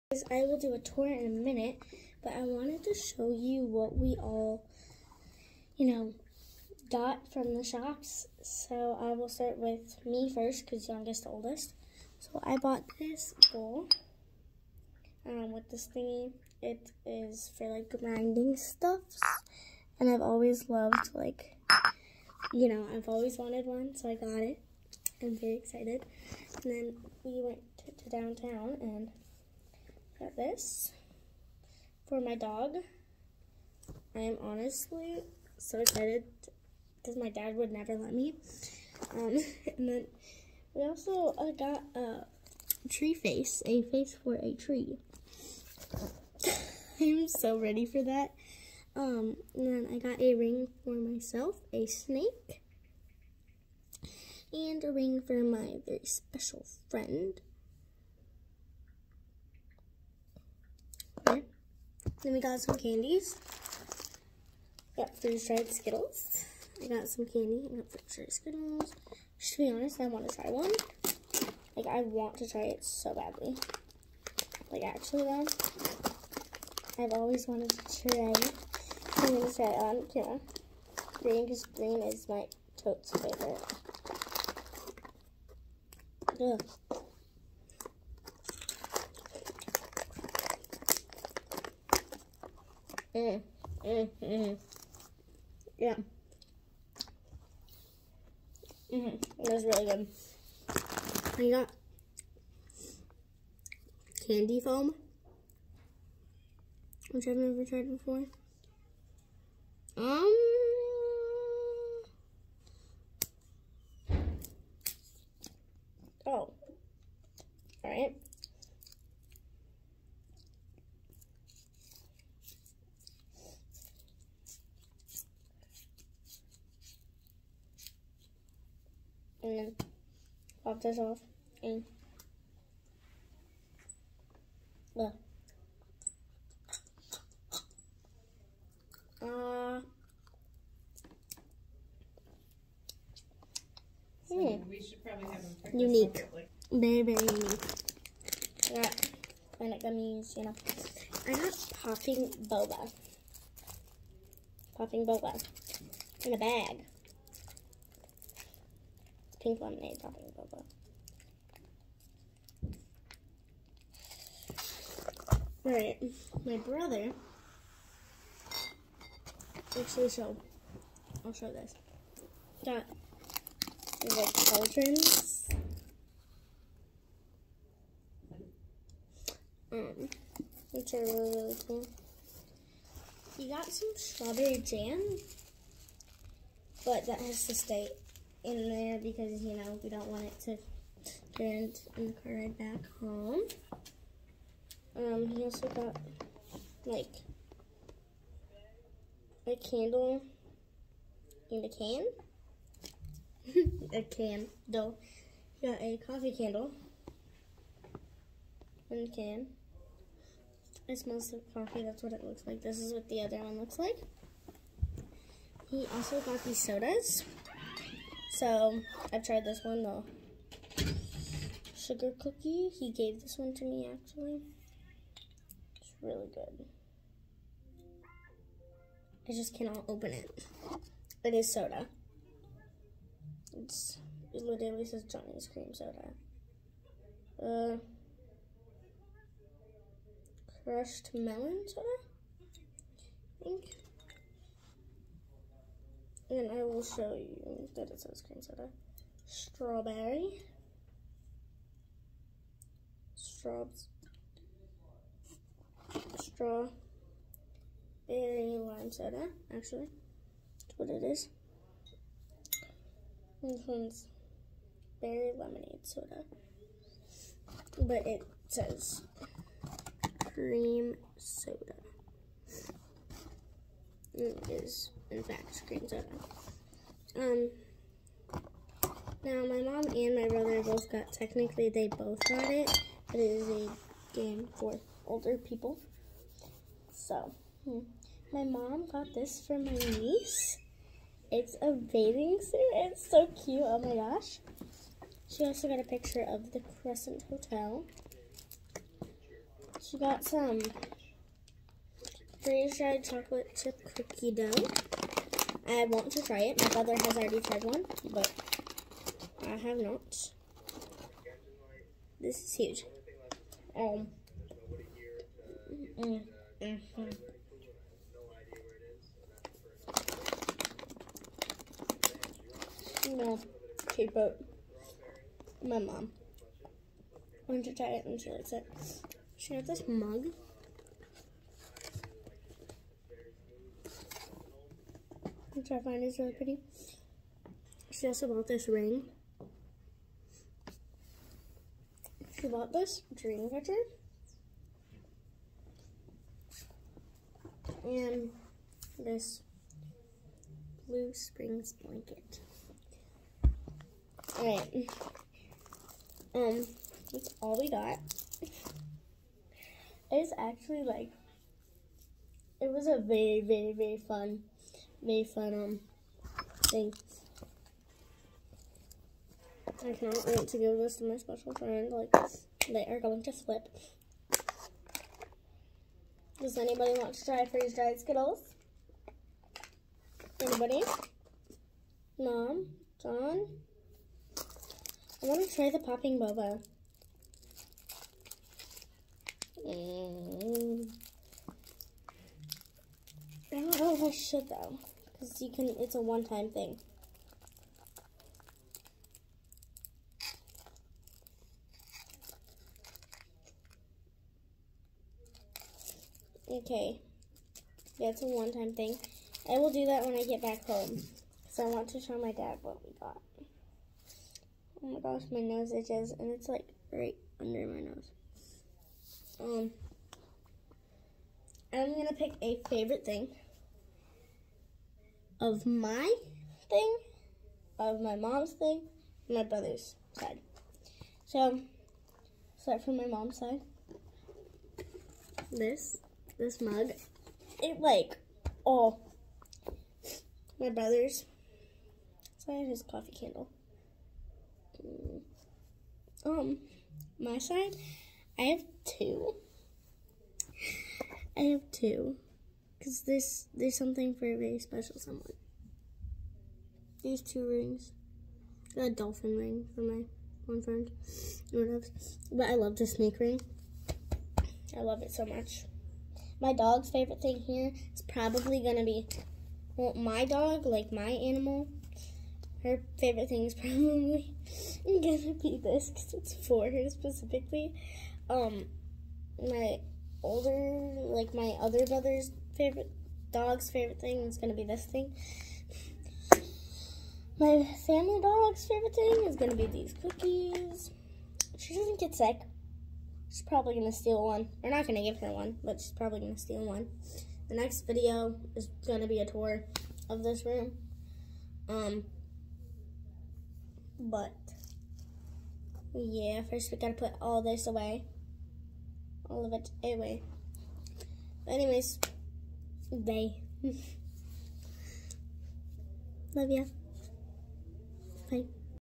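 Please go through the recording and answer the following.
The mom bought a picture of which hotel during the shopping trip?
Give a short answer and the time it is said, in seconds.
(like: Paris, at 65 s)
Crescent Hotel, at 296 s.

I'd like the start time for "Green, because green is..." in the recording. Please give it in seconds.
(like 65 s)
81 s.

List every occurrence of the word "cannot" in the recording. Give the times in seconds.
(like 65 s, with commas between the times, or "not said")
229 s, 369 s.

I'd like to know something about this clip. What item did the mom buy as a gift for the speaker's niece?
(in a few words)
Bathing suit.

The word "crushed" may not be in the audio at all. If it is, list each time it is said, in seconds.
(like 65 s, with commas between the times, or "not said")
240 s.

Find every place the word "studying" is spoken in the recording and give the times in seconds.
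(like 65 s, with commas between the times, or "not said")
not said.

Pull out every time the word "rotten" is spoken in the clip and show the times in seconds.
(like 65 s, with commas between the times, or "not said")
not said.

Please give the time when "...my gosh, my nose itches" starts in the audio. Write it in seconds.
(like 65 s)
414 s.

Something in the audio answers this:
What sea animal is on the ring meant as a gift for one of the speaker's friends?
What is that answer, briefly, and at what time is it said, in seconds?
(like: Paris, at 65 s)
Dolphin, at 458 s.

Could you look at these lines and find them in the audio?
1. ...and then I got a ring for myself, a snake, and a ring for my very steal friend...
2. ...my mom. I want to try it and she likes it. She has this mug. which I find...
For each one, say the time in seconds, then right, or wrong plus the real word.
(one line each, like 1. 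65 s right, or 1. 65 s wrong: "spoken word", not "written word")
1. 49 s wrong: "special", not "steal"
2. 325 s right.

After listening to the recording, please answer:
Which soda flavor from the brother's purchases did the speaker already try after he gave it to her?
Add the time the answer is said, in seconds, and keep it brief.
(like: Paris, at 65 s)
Sugar cookie, at 219 s.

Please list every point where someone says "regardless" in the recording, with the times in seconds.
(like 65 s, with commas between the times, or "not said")
not said.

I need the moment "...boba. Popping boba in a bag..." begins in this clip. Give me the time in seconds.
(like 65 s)
152 s.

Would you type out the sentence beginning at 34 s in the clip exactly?
I am honestly so excited because my dad would never let me.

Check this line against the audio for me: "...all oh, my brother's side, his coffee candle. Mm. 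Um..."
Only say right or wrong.
right.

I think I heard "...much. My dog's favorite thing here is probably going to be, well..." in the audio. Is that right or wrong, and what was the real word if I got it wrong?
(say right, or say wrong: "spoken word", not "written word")
right.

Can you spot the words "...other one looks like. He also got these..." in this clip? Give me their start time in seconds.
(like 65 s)
213 s.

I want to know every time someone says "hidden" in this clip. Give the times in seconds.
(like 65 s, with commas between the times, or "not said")
not said.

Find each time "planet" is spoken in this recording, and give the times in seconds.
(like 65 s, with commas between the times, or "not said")
149 s.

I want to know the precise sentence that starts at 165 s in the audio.
Alright, my brother, actually, so, I'll show this.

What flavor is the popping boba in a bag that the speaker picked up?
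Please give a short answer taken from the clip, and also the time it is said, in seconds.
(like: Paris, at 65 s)
Pink lemonade, at 159 s.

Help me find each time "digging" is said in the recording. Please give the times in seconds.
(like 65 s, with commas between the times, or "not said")
not said.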